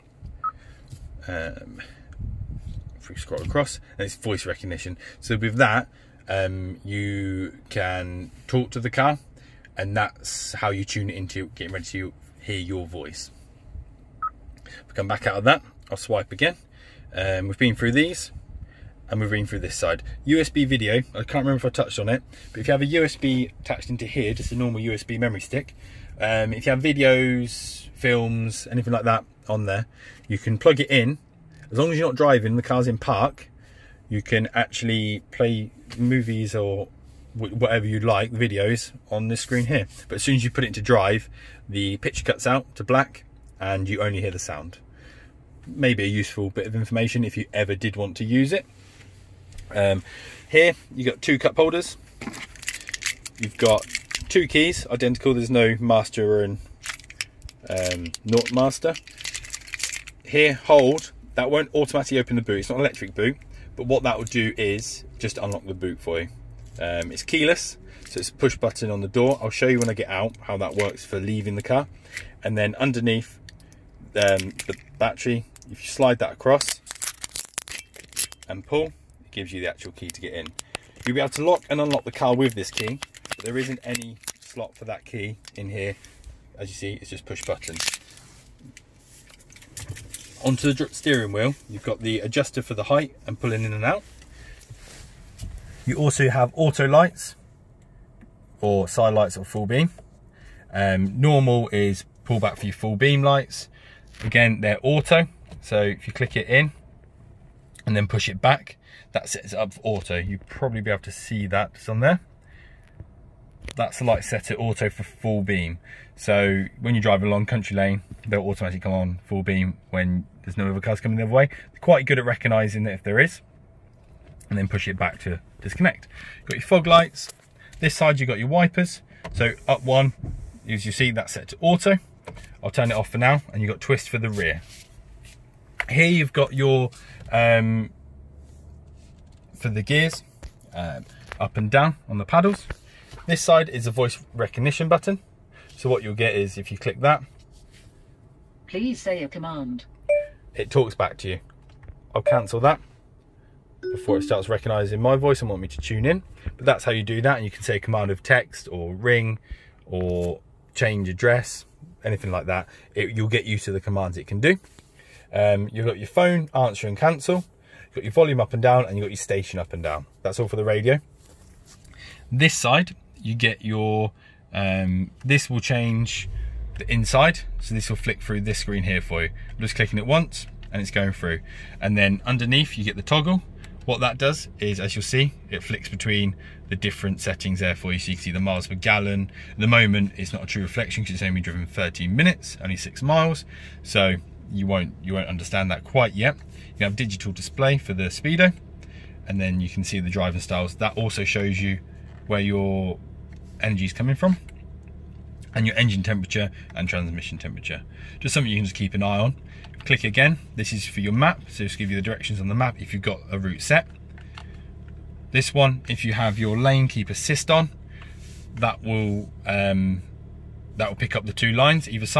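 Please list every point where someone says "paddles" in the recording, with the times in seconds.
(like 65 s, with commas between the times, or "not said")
142 s.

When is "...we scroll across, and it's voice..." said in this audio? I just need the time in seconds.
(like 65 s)
3 s.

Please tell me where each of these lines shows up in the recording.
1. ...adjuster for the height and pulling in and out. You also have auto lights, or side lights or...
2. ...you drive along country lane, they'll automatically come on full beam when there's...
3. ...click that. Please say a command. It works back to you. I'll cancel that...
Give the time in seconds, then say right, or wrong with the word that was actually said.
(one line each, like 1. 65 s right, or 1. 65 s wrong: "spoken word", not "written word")
1. 92 s right
2. 116 s right
3. 146 s wrong: "talks", not "works".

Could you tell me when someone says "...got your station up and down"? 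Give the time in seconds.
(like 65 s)
169 s.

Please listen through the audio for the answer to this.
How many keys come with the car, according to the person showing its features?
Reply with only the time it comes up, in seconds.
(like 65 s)
54 s.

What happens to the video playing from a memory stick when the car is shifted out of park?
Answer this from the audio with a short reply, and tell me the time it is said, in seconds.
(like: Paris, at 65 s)
Cuts out to black, at 42 s.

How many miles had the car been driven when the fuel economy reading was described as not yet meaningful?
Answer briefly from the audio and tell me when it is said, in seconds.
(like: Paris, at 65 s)
6, at 192 s.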